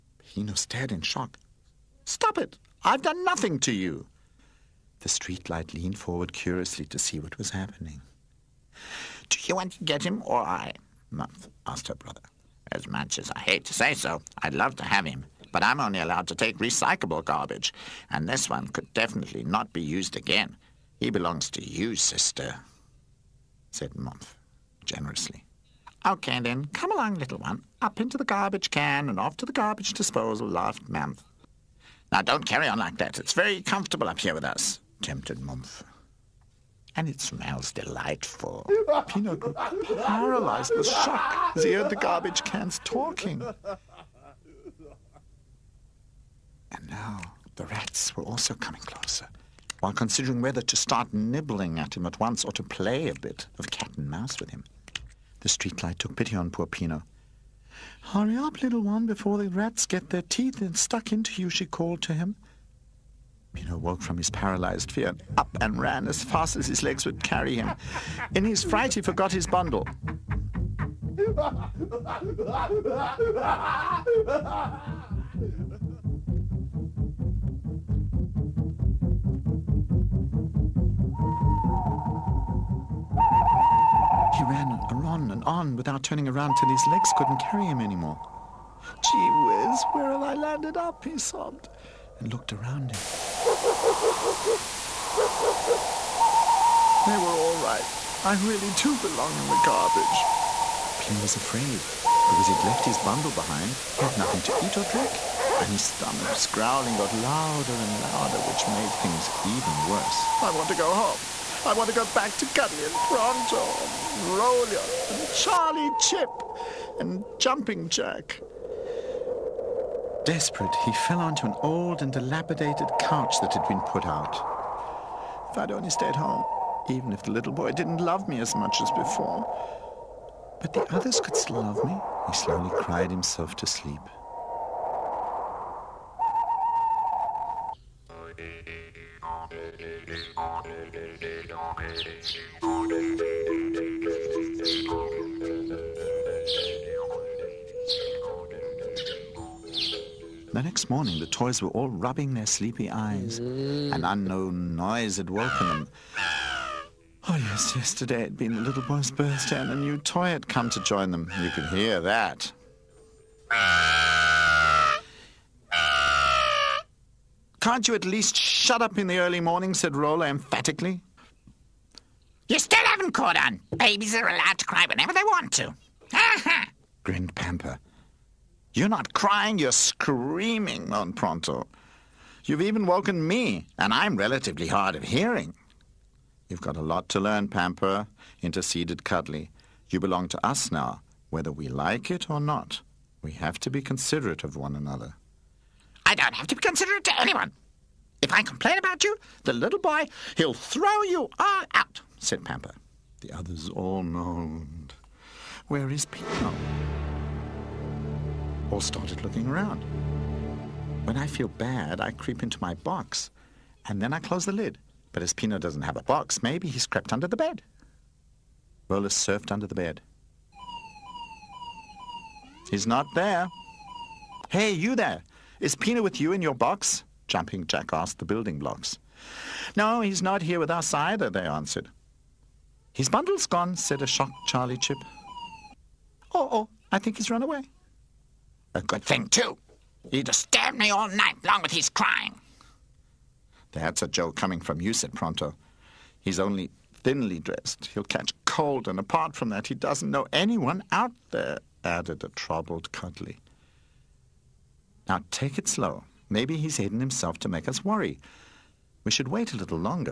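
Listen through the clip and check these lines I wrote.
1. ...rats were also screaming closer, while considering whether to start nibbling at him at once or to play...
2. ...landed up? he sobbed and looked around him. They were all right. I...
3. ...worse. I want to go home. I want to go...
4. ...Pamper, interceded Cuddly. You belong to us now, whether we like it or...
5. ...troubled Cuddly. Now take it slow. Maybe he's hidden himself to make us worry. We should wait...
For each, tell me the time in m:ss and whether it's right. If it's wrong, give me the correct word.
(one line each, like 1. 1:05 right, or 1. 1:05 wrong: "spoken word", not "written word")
1. 0:47 wrong: "coming", not "screaming"
2. 1:30 right
3. 1:49 right
4. 3:07 right
5. 4:12 right.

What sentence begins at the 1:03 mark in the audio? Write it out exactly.
He woke from his paralyzed fear, up and ran as fast as his legs would carry him.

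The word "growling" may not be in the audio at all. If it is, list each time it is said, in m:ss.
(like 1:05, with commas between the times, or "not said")
1:46.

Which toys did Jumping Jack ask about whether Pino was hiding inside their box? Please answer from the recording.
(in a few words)
Building blocks.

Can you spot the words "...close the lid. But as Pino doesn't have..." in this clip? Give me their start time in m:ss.
3:34.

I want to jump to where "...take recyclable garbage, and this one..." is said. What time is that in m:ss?
0:16.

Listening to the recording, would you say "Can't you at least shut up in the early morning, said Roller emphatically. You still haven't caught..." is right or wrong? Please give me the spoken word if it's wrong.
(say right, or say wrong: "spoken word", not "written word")
right.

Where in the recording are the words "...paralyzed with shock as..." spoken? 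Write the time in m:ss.
0:40.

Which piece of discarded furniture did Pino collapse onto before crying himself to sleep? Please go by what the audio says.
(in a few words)
Couch.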